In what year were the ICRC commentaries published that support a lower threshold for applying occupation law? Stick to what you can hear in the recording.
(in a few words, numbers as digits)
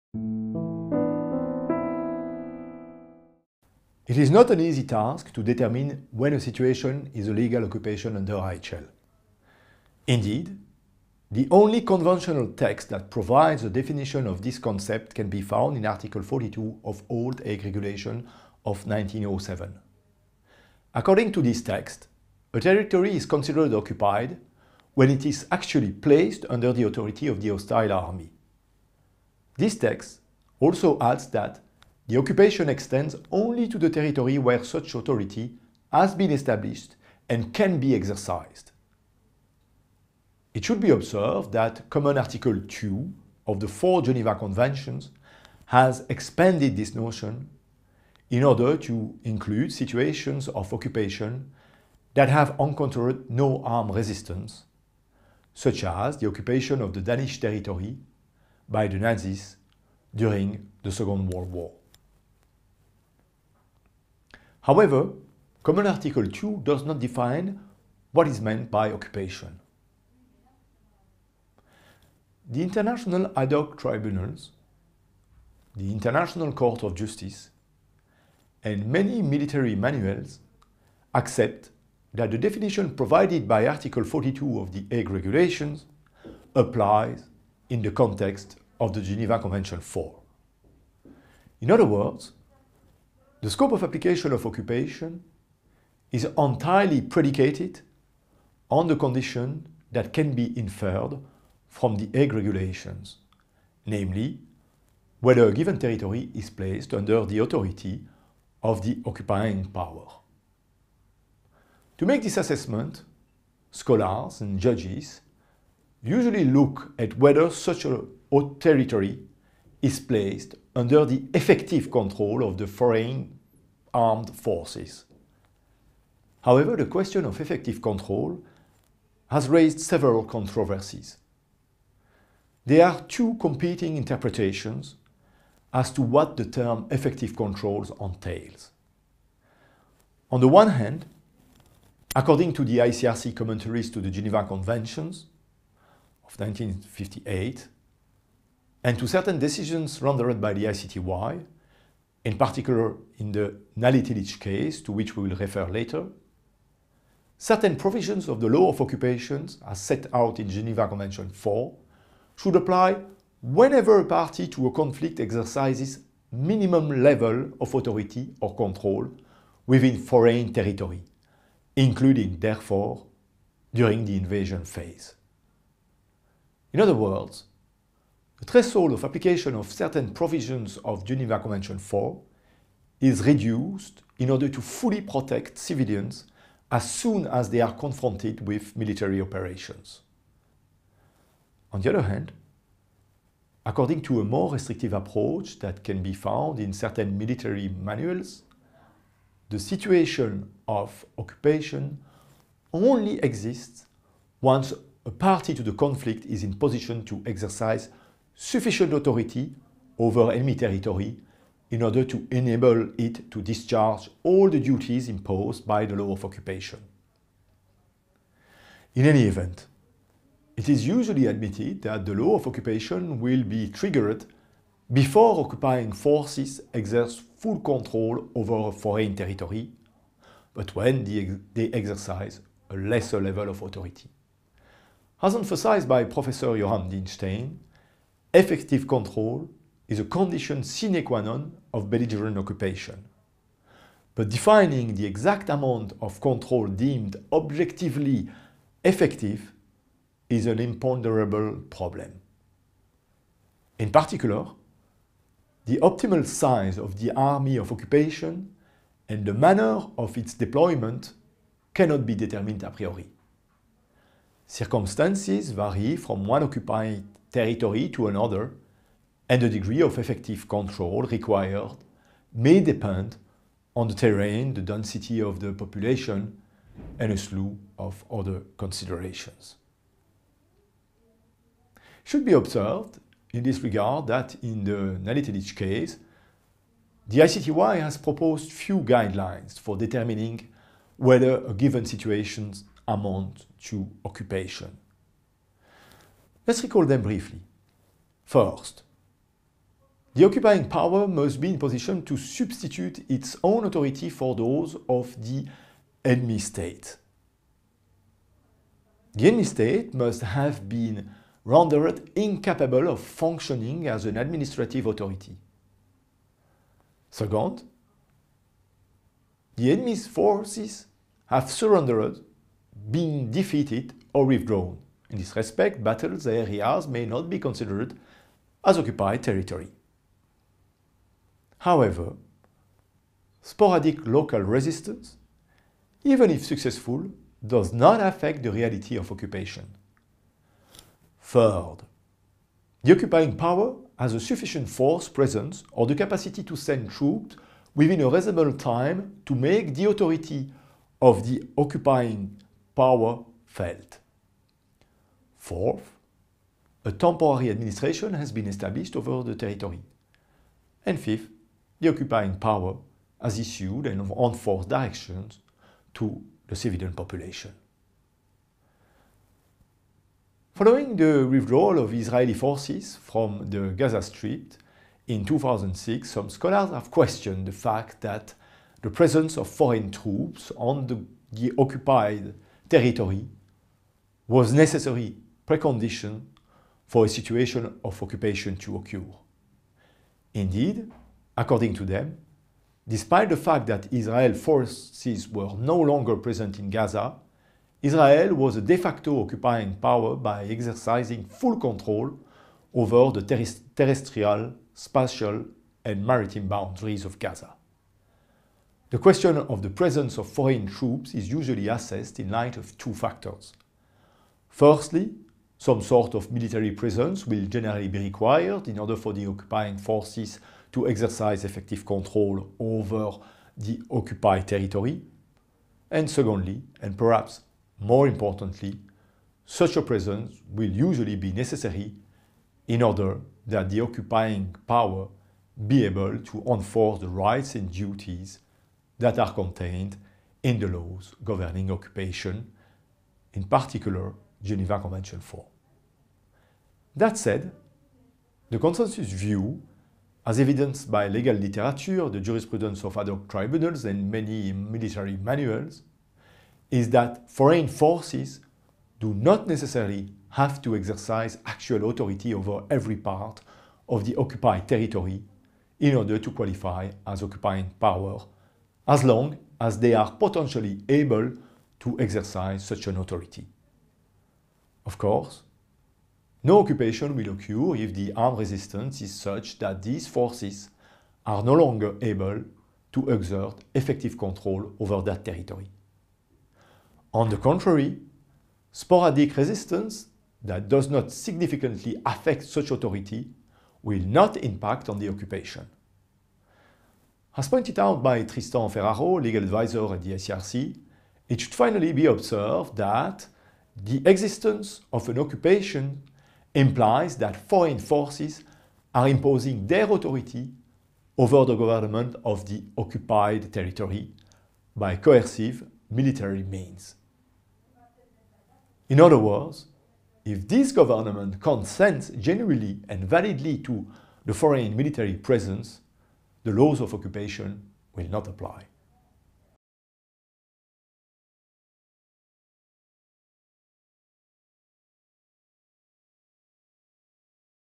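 1958.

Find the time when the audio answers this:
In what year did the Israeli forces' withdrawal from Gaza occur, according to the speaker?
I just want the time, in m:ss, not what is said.
6:15.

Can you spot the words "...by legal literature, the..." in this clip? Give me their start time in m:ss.
7:30.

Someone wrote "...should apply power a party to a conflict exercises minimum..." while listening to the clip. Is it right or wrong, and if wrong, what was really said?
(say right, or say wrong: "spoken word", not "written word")
wrong: "whenever", not "power".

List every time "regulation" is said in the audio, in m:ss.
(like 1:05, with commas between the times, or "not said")
0:17, 1:25, 1:42.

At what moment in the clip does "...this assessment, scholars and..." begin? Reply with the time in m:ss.
1:52.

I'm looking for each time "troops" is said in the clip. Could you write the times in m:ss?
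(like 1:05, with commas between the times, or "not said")
5:46, 6:19, 6:50.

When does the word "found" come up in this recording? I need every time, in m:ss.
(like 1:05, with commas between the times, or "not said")
0:15, 3:16.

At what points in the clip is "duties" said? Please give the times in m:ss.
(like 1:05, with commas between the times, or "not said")
3:34, 7:17.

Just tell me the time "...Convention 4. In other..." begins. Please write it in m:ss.
1:29.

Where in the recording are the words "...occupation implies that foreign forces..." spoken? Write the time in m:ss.
8:25.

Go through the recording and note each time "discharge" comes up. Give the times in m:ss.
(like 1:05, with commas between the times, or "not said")
3:33.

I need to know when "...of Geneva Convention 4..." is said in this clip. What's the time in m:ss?
3:00.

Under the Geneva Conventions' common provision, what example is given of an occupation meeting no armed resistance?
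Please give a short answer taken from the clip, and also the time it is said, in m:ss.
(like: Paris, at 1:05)
Danish territory by the Nazis, at 0:56.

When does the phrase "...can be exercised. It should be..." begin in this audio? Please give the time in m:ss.
0:37.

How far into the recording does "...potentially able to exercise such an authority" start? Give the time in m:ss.
7:50.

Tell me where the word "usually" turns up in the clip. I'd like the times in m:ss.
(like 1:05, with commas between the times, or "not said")
1:56, 3:40, 6:51, 7:10.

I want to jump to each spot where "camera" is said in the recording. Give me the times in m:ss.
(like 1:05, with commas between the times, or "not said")
not said.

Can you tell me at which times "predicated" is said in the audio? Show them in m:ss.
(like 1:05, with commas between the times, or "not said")
1:37.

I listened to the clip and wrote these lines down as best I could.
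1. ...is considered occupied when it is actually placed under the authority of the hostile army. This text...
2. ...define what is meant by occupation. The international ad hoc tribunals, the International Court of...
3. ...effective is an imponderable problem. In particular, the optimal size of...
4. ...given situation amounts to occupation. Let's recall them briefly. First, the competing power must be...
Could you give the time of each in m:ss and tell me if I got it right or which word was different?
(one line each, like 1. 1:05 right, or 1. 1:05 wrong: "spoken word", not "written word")
1. 0:23 right
2. 1:06 right
3. 4:08 right
4. 4:51 wrong: "occupying", not "competing".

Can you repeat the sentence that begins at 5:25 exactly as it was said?
In this respect, battled areas may not be considered as occupied territory.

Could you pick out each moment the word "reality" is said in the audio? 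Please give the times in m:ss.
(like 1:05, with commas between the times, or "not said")
5:38.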